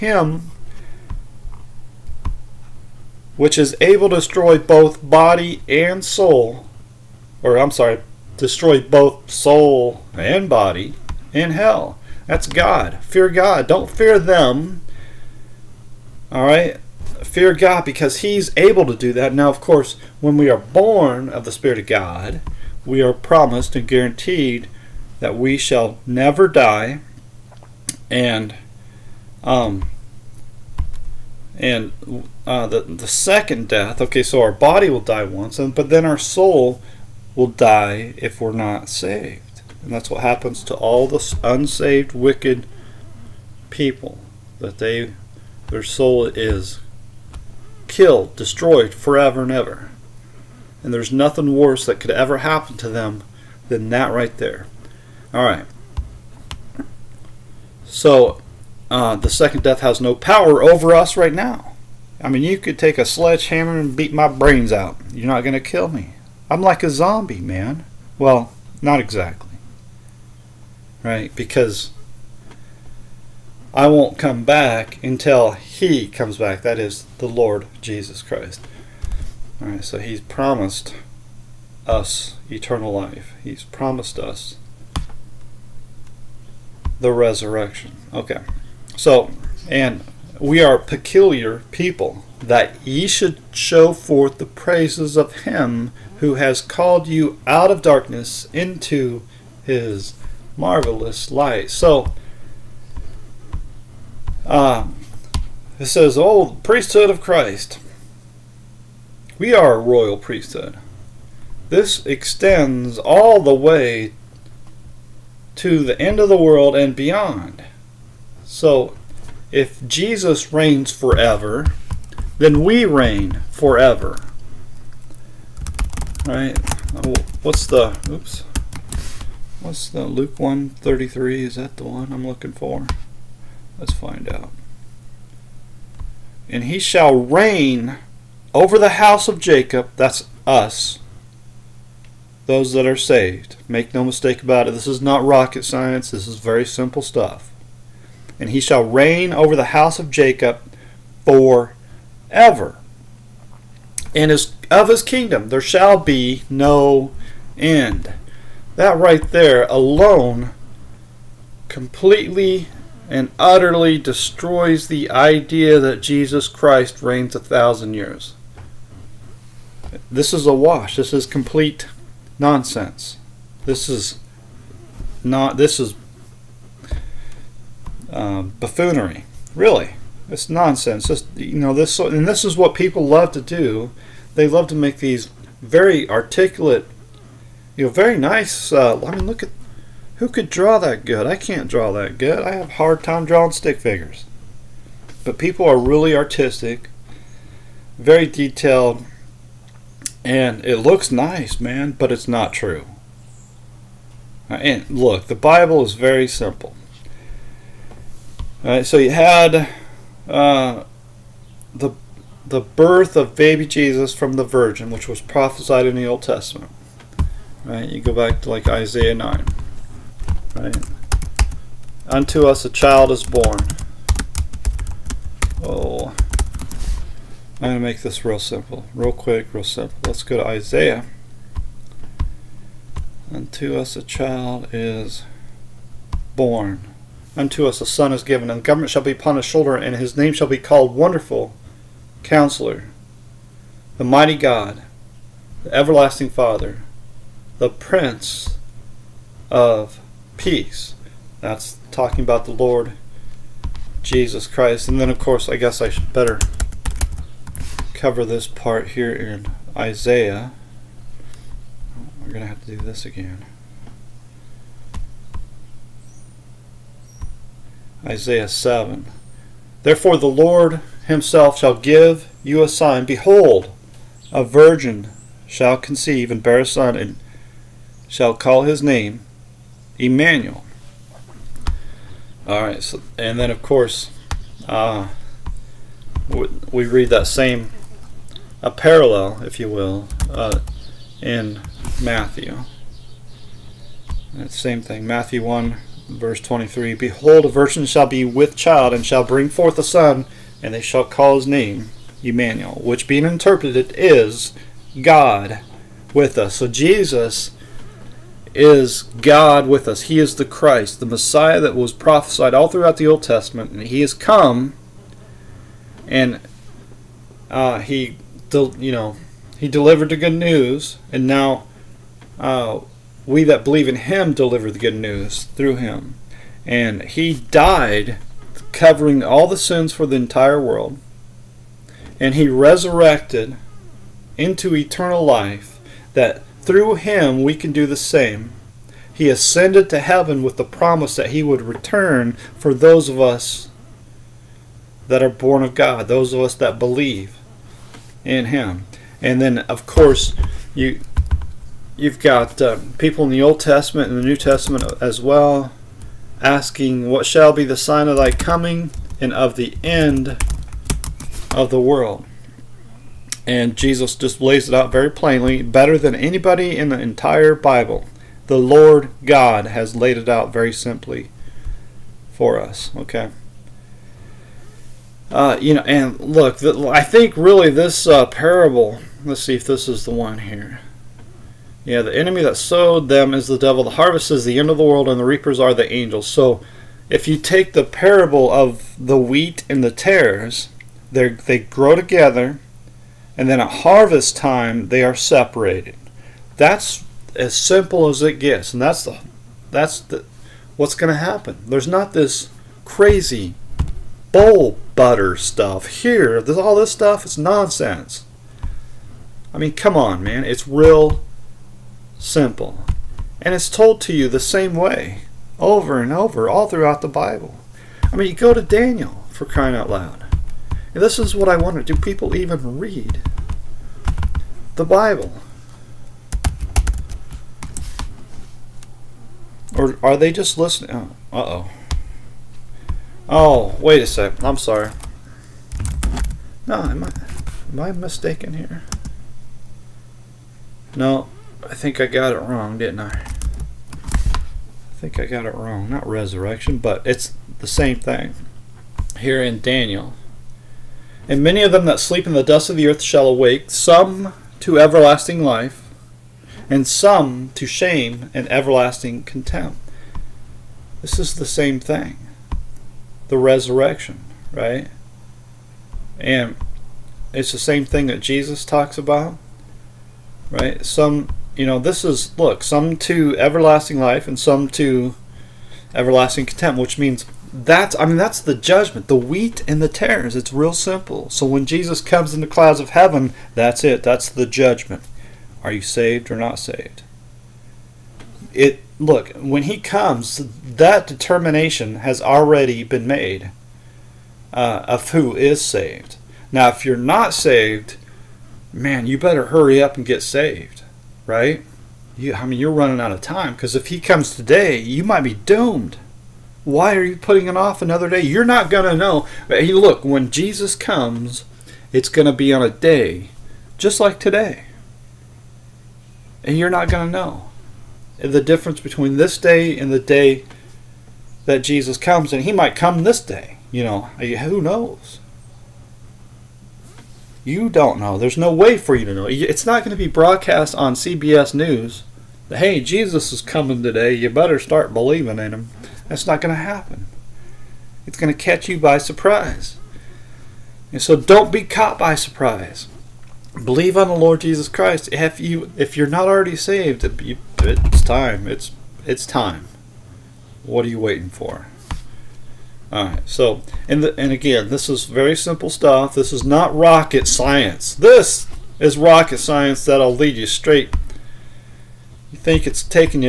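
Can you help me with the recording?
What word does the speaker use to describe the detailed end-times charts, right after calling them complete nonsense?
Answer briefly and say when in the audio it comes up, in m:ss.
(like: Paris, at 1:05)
buffoonery, at 2:58.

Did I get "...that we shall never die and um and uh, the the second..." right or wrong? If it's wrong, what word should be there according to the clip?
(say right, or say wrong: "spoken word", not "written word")
right.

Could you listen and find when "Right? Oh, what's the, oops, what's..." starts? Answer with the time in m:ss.
2:06.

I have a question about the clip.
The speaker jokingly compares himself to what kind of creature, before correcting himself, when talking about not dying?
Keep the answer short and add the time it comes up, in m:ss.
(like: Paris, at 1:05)
zombie, at 1:06.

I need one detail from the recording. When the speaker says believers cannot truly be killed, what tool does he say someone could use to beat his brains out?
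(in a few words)
sledgehammer.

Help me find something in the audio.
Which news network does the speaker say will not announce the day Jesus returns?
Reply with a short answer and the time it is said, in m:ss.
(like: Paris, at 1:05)
CBS News, at 8:50.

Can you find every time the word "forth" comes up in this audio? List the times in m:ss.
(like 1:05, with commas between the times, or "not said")
1:33, 4:59.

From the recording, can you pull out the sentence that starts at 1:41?
So, uh, it says, Oh, priesthood of Christ.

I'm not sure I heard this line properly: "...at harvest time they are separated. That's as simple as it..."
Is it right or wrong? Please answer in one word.
right.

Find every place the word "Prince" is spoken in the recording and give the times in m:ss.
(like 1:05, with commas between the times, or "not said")
4:07.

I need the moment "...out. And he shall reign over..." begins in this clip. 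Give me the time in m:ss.
2:14.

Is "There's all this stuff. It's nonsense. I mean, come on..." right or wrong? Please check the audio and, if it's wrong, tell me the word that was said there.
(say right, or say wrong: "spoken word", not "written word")
right.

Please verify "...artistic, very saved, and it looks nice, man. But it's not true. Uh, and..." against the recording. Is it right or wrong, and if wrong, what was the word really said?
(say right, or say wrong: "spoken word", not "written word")
wrong: "detailed", not "saved".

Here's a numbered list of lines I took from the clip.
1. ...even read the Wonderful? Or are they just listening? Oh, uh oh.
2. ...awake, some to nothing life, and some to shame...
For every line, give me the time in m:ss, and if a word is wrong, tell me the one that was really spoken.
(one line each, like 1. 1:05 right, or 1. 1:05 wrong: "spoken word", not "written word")
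1. 7:02 wrong: "Bible", not "Wonderful"
2. 7:33 wrong: "everlasting", not "nothing".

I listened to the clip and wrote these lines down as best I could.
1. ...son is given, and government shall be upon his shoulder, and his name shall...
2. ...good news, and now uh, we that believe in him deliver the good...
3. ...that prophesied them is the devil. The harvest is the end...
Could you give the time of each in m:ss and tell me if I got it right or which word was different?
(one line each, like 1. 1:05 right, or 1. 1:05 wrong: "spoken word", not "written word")
1. 3:57 right
2. 5:20 right
3. 6:22 wrong: "sowed", not "prophesied".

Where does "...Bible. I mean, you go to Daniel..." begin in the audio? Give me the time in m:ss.
6:57.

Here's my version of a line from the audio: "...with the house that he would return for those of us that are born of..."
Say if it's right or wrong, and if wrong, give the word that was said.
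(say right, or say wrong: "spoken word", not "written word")
wrong: "promise", not "house".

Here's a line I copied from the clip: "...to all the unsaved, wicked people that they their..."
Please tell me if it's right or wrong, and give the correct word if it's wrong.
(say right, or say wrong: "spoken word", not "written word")
right.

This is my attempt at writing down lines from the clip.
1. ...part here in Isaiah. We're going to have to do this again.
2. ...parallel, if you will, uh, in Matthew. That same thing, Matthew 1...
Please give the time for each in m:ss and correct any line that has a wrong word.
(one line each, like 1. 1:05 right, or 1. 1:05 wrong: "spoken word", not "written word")
1. 4:18 right
2. 4:48 right.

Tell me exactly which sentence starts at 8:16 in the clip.
Now, if you're not saved, man, you better hurry up and get saved right?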